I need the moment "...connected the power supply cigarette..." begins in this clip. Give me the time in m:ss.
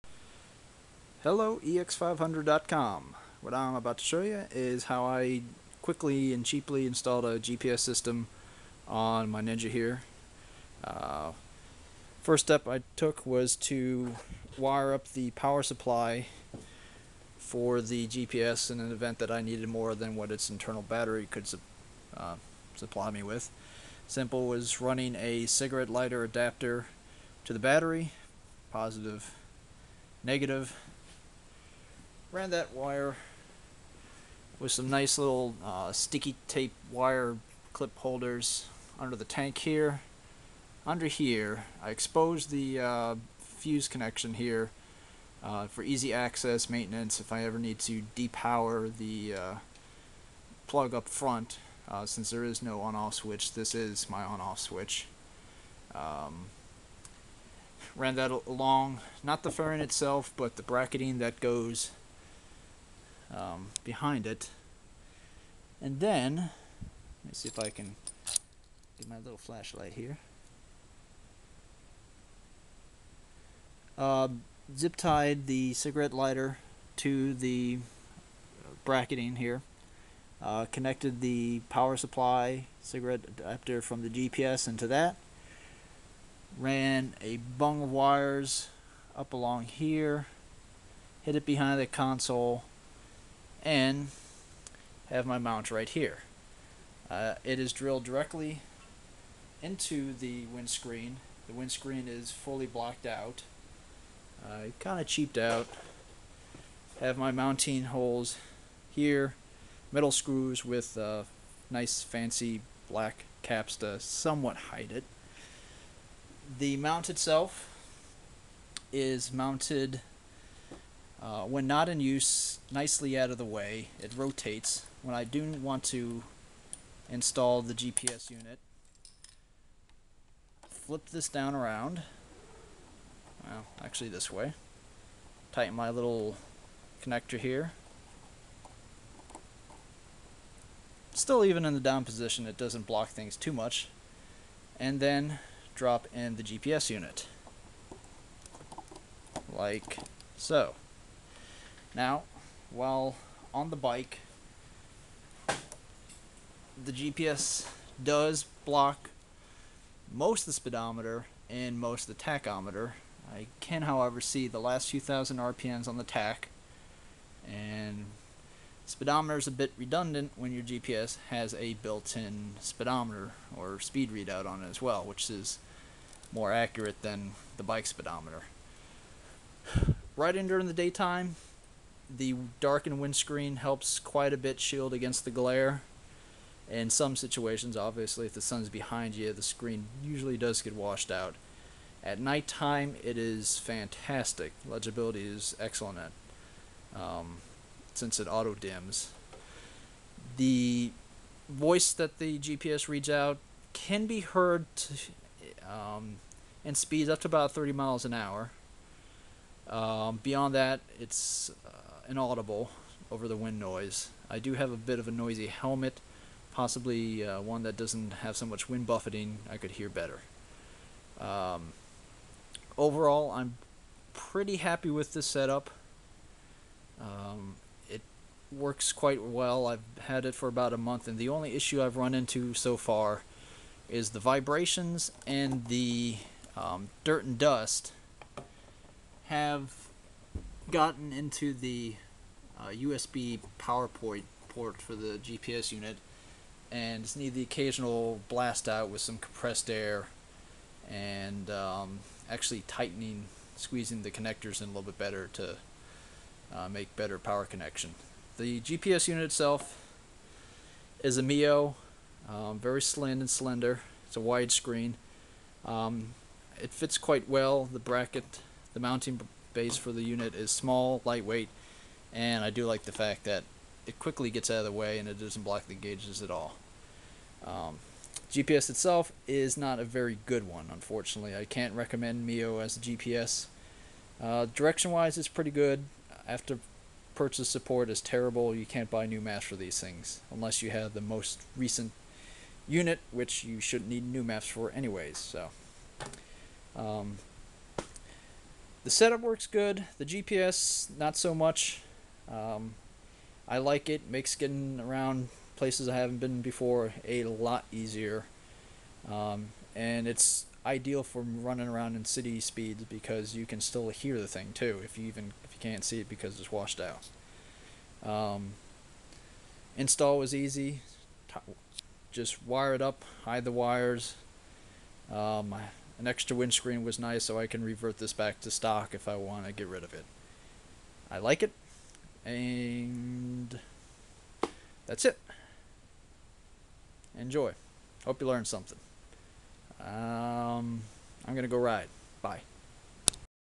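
1:20.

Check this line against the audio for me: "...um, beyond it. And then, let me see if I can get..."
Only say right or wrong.
wrong.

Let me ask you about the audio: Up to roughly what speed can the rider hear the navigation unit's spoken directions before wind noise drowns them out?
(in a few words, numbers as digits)
30 mph.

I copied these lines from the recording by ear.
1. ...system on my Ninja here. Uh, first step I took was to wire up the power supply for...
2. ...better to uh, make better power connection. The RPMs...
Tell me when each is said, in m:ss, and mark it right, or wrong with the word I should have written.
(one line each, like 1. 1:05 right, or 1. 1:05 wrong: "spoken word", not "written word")
1. 0:07 right
2. 4:14 wrong: "GPS", not "RPMs".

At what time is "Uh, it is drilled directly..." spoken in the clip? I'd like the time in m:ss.
1:37.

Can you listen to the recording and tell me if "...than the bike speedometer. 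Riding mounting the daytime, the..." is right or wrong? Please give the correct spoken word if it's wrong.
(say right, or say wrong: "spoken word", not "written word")
wrong: "during", not "mounting".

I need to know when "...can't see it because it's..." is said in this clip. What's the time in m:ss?
5:15.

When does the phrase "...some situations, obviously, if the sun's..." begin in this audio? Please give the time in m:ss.
3:06.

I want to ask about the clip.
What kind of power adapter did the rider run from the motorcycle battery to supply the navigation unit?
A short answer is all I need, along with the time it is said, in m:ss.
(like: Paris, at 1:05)
cigarette lighter adapter, at 0:25.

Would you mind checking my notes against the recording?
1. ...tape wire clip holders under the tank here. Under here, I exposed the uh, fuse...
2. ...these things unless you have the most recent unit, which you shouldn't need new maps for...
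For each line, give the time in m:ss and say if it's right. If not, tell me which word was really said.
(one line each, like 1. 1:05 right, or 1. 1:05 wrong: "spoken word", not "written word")
1. 0:36 right
2. 4:49 right.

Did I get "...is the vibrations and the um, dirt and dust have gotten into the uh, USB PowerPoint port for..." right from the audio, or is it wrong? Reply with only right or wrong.
right.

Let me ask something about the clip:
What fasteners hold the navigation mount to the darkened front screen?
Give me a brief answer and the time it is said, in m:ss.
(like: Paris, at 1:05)
metal screws, at 1:49.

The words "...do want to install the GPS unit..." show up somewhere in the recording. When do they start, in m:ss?
2:05.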